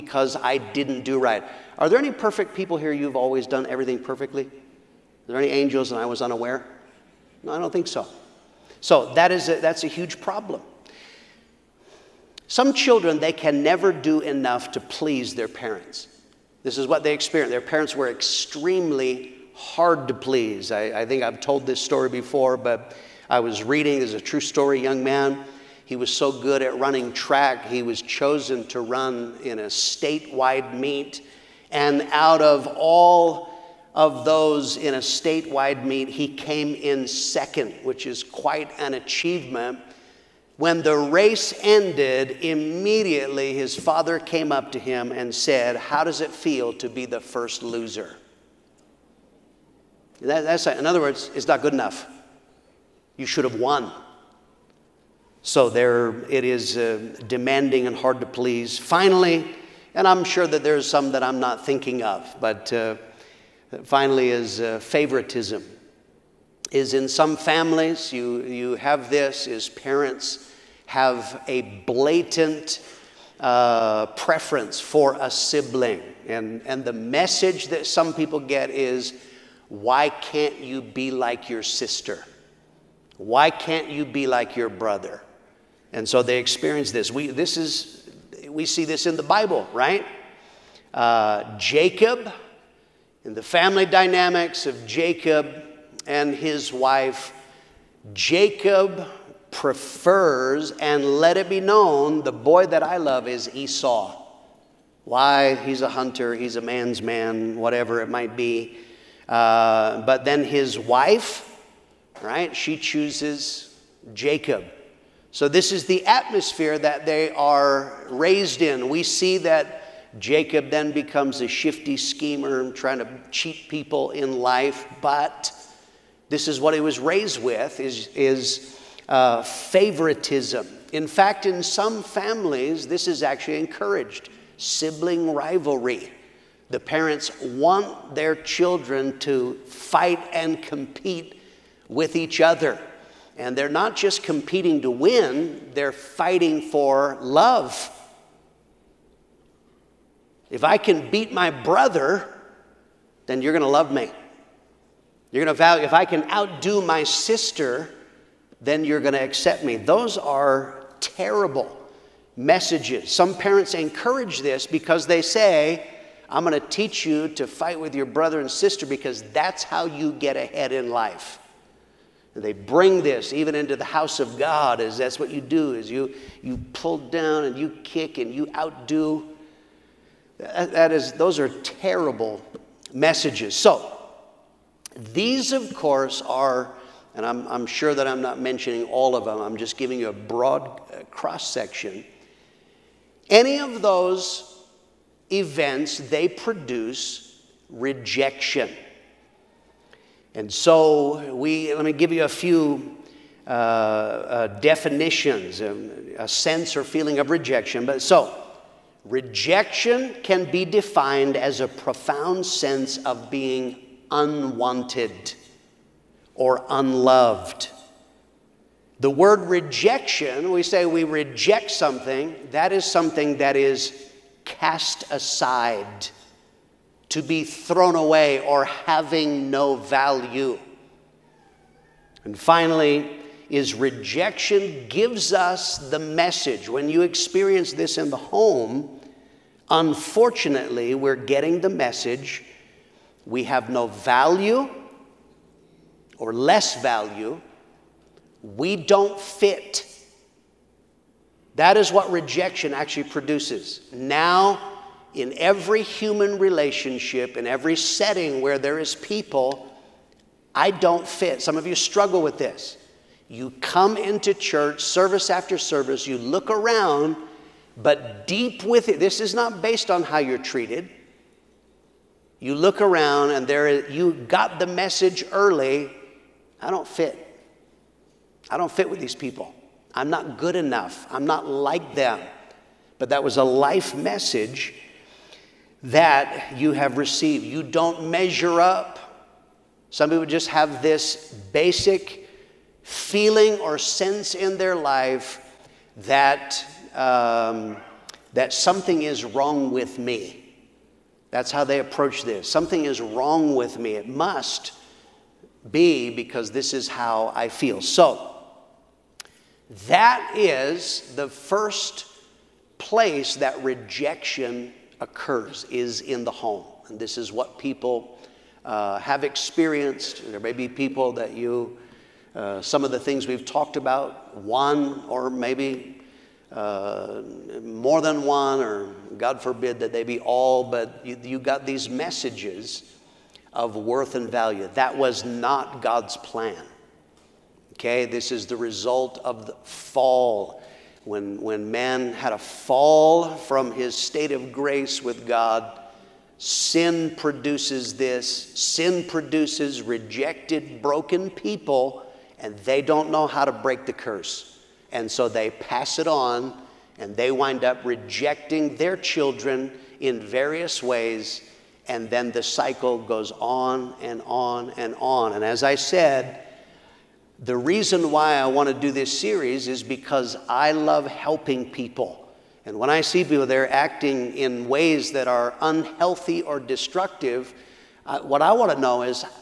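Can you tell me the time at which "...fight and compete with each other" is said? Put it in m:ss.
2:19.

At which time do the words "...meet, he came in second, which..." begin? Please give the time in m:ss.
0:35.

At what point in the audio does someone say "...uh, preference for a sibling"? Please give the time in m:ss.
1:13.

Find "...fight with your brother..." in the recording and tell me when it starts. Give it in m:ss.
2:47.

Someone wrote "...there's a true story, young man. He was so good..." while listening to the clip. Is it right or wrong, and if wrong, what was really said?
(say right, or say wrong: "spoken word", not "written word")
right.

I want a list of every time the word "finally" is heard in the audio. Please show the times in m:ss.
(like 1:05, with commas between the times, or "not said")
0:58, 1:03, 3:52.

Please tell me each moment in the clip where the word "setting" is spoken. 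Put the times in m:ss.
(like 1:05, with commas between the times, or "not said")
4:17.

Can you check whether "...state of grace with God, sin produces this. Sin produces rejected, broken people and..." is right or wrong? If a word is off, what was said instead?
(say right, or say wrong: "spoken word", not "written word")
right.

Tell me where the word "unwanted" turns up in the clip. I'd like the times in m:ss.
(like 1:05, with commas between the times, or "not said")
3:34.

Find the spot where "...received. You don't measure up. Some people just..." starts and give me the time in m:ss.
4:46.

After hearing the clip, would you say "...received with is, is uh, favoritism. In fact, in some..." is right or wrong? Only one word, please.
wrong.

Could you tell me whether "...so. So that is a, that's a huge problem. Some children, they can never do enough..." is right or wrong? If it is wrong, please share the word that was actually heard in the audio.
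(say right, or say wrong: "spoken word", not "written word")
right.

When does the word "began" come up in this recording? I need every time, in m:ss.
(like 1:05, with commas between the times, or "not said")
not said.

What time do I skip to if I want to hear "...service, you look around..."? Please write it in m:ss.
4:25.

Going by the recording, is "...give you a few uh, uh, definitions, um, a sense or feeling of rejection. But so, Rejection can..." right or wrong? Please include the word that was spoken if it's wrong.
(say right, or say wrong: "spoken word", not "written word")
right.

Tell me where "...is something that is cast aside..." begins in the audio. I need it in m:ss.
3:42.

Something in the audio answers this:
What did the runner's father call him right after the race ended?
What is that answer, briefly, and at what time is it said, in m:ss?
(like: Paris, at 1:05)
The first loser, at 0:47.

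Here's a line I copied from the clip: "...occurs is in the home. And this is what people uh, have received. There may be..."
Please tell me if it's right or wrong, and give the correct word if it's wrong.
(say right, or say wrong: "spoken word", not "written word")
wrong: "experienced", not "received".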